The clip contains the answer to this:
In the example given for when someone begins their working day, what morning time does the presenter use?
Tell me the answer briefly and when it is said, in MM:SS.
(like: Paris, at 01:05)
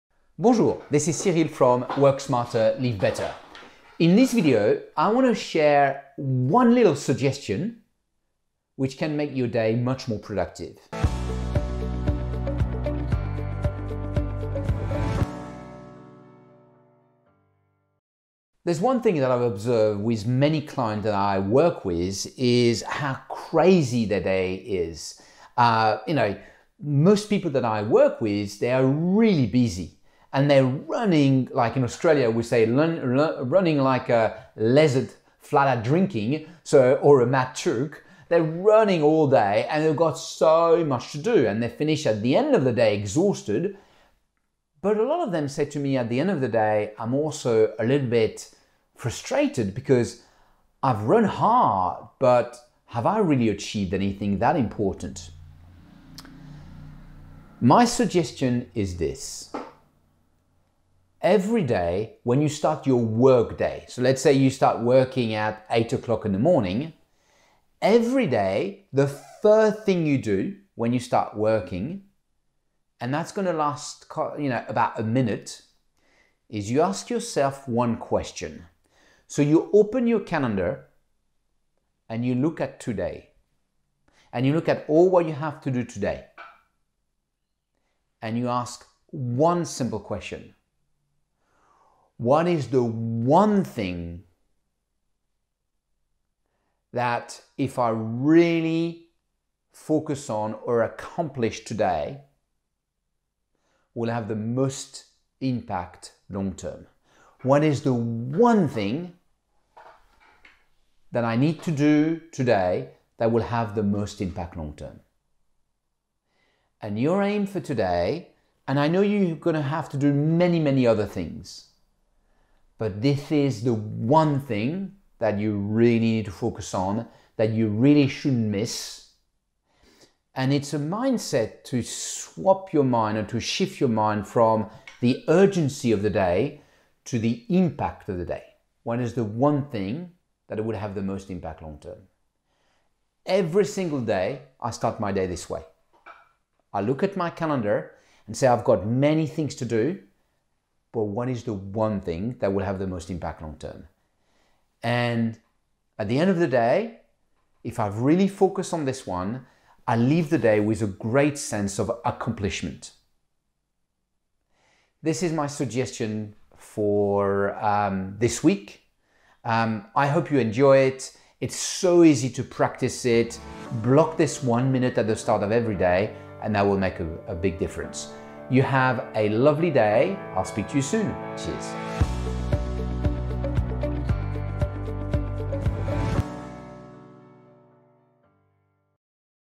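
8 o'clock, at 01:05.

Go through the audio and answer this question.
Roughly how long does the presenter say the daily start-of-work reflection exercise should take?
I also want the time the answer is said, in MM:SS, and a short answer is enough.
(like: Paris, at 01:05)
about a minute, at 01:14.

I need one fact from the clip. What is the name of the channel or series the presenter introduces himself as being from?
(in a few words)
Work Smarter, Live Better.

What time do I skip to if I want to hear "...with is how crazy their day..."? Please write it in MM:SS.
00:21.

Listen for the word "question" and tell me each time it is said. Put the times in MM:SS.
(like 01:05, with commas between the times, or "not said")
01:17, 01:29.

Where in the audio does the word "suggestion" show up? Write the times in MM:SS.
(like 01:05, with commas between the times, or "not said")
00:06, 00:57, 02:45.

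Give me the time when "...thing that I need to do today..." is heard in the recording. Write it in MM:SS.
01:48.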